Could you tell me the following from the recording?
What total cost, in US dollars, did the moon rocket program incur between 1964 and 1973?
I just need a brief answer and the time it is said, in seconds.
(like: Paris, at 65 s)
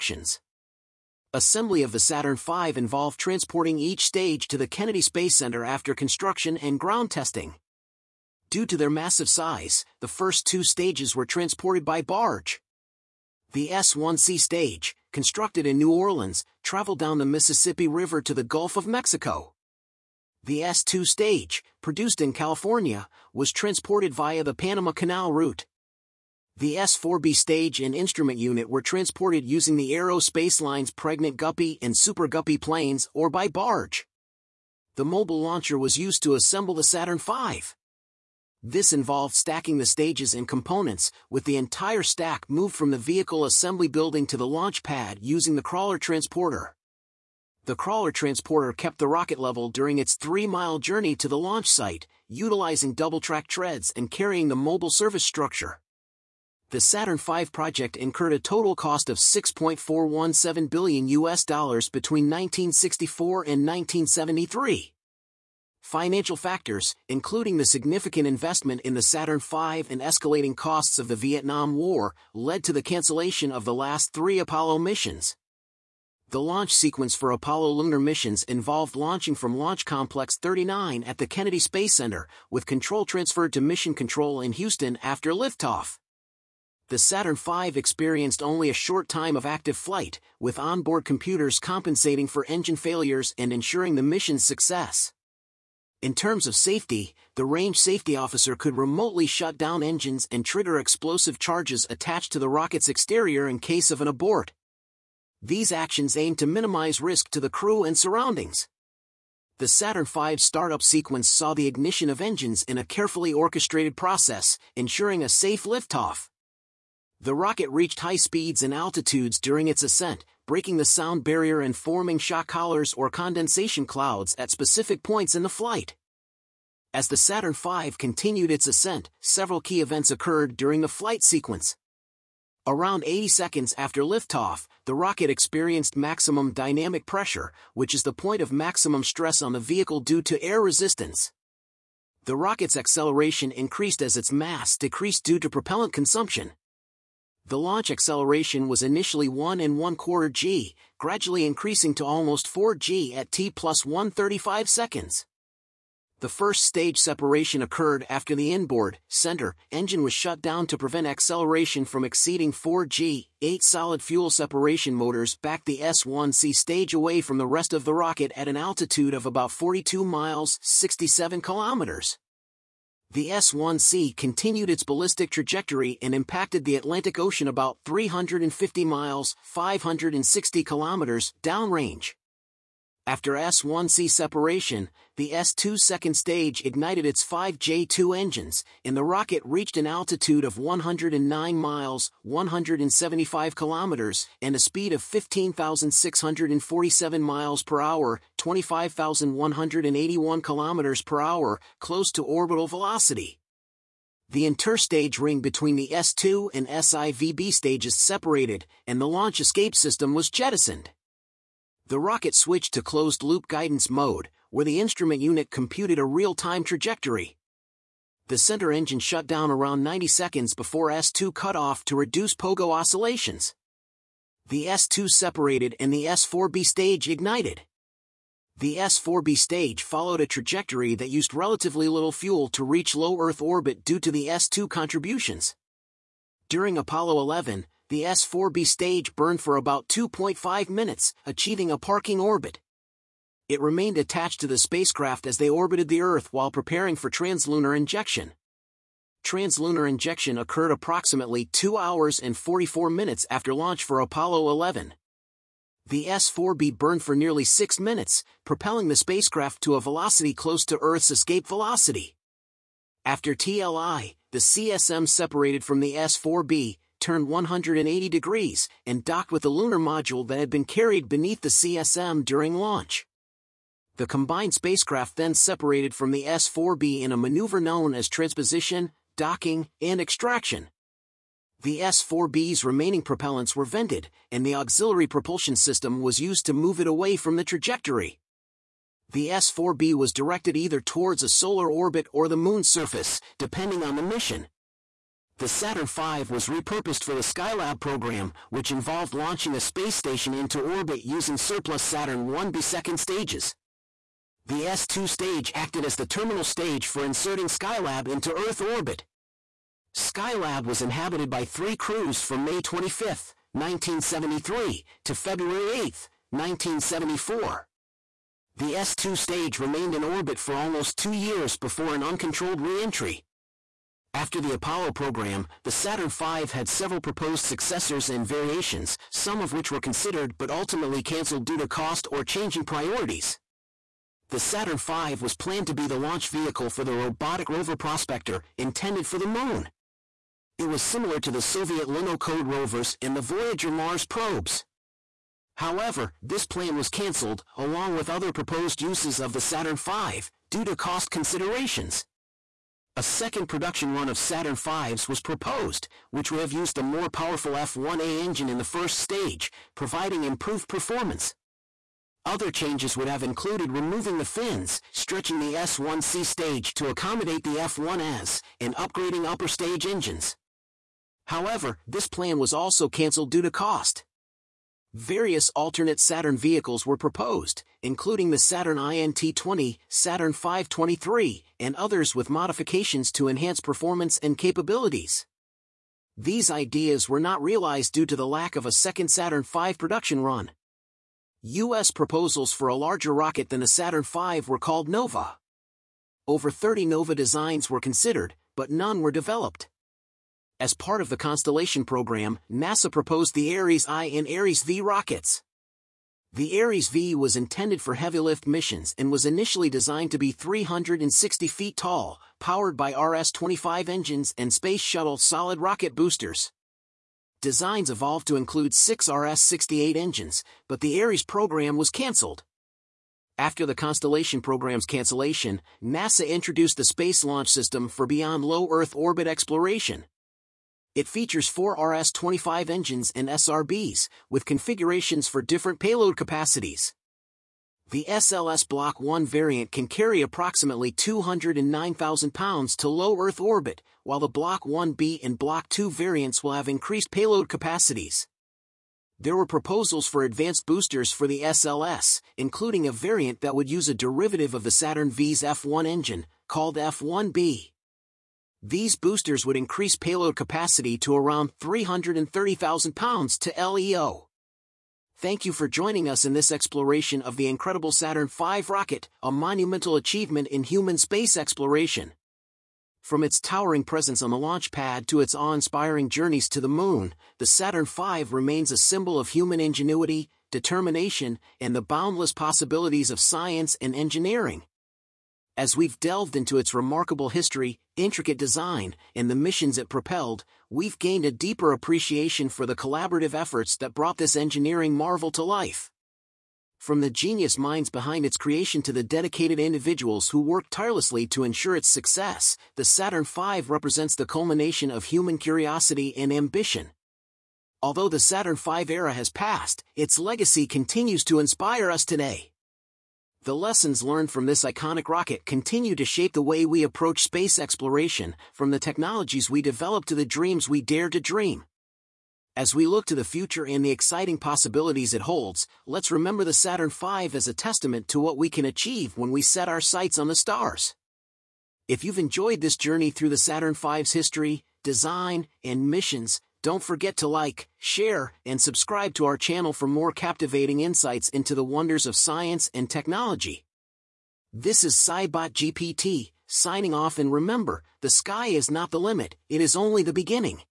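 6.417 billion, at 59 s.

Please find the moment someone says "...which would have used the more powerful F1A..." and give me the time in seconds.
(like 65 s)
356 s.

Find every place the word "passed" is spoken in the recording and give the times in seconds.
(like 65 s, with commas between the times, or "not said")
509 s.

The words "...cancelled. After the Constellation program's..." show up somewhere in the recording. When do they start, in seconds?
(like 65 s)
421 s.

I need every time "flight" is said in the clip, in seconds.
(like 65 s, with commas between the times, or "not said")
89 s, 125 s, 130 s.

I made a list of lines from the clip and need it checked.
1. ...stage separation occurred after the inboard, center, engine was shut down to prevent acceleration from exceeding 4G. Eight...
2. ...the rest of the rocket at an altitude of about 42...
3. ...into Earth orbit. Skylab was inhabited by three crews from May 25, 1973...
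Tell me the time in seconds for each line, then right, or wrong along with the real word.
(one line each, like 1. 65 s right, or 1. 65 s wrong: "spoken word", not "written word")
1. 156 s right
2. 167 s right
3. 308 s right.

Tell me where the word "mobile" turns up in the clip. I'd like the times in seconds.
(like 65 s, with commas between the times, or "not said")
35 s, 54 s.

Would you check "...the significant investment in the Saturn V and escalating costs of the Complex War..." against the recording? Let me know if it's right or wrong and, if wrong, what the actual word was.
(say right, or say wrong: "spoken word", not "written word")
wrong: "Vietnam", not "Complex".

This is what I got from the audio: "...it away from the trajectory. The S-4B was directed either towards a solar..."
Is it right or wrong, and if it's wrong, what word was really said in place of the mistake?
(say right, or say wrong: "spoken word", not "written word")
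right.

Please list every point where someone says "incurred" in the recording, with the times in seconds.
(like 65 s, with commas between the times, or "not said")
57 s.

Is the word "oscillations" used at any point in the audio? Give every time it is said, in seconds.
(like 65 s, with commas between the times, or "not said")
222 s.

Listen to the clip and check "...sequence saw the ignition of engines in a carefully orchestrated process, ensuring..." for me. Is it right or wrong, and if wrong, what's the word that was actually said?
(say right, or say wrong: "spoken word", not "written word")
right.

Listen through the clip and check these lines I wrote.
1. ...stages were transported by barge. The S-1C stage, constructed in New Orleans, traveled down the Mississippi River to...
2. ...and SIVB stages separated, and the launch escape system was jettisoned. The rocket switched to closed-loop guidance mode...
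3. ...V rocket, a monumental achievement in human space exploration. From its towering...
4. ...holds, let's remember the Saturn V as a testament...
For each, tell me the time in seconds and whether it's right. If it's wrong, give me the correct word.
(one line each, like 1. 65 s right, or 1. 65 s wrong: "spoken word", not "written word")
1. 10 s right
2. 206 s right
3. 468 s right
4. 525 s right.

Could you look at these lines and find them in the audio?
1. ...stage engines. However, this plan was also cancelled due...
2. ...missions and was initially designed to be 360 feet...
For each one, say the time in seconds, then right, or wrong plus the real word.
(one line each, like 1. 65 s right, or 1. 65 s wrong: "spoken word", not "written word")
1. 369 s right
2. 408 s right.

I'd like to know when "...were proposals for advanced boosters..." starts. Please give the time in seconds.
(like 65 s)
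449 s.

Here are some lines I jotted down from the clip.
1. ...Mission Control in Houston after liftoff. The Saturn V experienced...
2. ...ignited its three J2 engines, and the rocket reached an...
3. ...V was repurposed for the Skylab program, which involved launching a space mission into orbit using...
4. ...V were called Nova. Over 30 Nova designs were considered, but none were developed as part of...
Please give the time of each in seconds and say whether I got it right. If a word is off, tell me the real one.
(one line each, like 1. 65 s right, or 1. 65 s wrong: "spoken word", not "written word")
1. 83 s right
2. 186 s wrong: "five", not "three"
3. 295 s wrong: "station", not "mission"
4. 394 s right.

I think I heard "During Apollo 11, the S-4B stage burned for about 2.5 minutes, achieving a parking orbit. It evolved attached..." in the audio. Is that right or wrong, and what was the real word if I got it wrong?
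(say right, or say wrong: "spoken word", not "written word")
wrong: "remained", not "evolved".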